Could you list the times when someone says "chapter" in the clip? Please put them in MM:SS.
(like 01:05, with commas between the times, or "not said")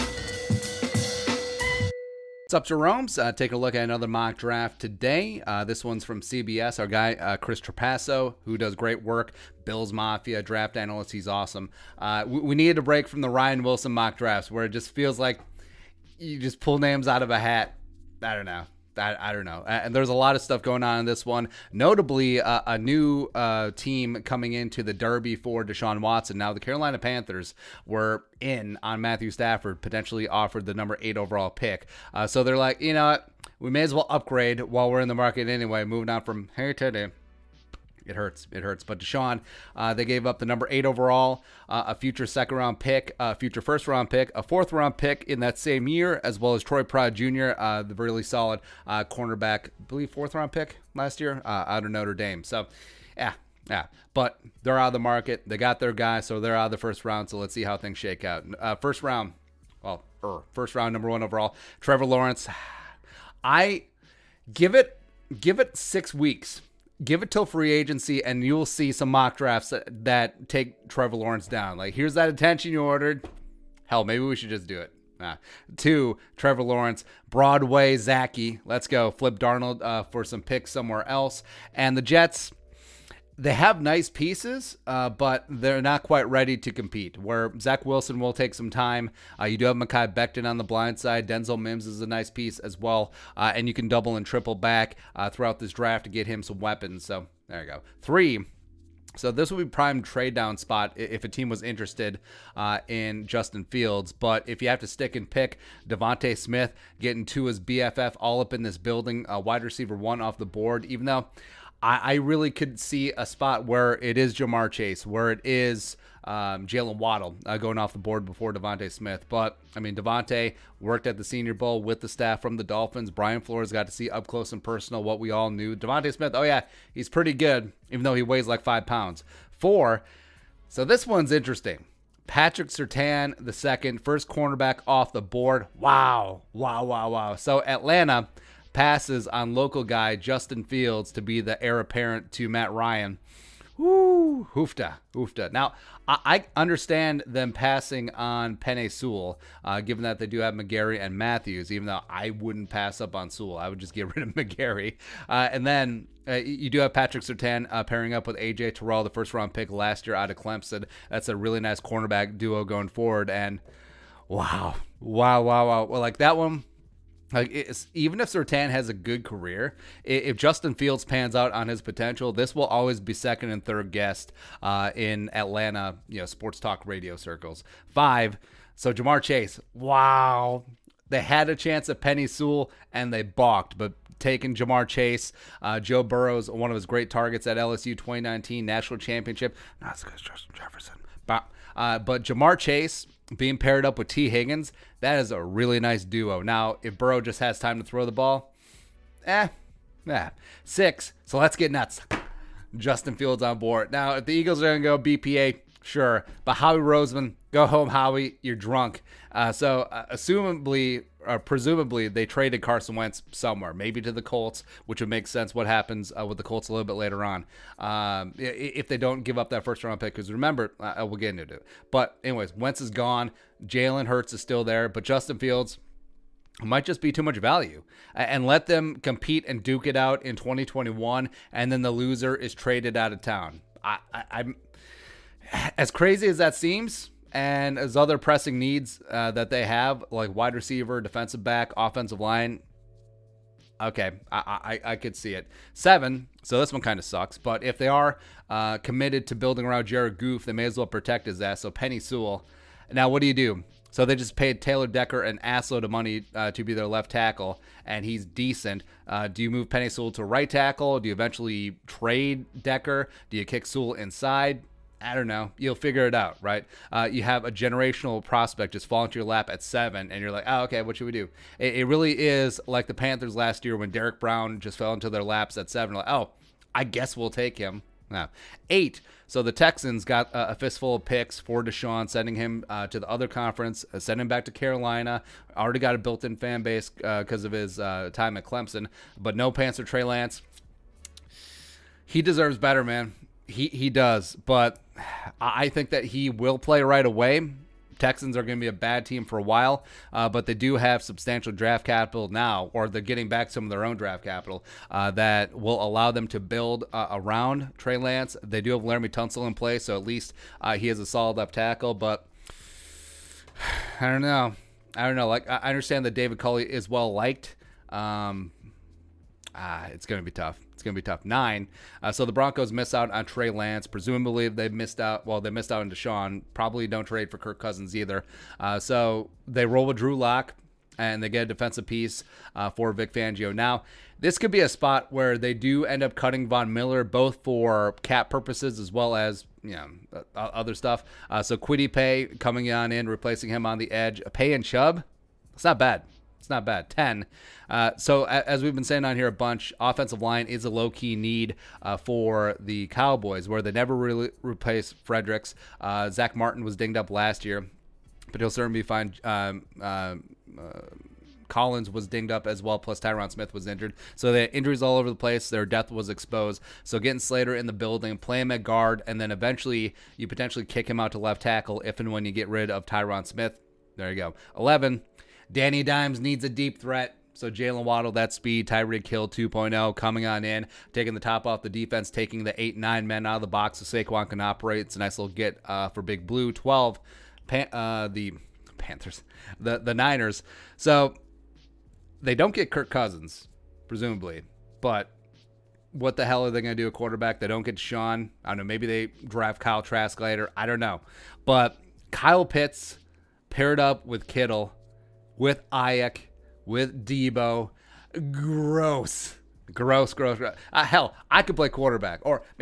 not said.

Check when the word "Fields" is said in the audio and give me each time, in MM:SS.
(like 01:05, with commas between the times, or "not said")
01:43, 02:20, 02:50, 03:23, 03:45.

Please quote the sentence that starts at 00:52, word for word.
So, yeah, yeah, but they're out of the market.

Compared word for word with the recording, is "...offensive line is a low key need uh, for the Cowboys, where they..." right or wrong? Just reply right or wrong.
right.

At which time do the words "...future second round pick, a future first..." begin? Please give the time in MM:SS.
00:41.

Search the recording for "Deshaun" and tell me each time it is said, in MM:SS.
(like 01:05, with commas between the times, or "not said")
00:25, 00:38, 04:41, 05:25.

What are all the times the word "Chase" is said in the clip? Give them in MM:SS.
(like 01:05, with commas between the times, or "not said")
01:54, 02:59, 03:04, 03:12.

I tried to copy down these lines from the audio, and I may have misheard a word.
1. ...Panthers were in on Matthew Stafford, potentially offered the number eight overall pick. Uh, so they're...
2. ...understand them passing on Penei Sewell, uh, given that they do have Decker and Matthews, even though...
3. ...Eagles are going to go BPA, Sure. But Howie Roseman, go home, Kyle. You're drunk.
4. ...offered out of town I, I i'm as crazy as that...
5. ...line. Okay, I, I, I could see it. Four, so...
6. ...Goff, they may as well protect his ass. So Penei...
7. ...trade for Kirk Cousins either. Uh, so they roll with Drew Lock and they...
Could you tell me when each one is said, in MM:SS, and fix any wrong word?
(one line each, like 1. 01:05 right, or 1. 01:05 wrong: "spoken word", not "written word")
1. 00:26 right
2. 02:26 wrong: "McGary", not "Decker"
3. 03:24 wrong: "Howie", not "Kyle"
4. 03:52 wrong: "traded", not "offered"
5. 04:02 wrong: "Seven", not "Four"
6. 04:10 right
7. 05:27 right.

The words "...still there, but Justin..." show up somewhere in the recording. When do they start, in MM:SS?
03:44.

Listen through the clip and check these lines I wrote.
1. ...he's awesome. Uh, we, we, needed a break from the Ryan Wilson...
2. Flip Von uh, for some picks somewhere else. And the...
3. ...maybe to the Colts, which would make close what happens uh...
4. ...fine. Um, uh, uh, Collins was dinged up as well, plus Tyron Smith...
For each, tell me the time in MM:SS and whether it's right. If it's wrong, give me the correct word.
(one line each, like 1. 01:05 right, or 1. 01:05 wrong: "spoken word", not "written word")
1. 00:11 right
2. 01:19 wrong: "Darnold", not "Von"
3. 03:33 wrong: "sense", not "close"
4. 05:58 right.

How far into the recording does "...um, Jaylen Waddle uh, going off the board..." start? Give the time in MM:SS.
01:56.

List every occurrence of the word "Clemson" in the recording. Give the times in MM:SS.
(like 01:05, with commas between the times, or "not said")
02:40, 04:48.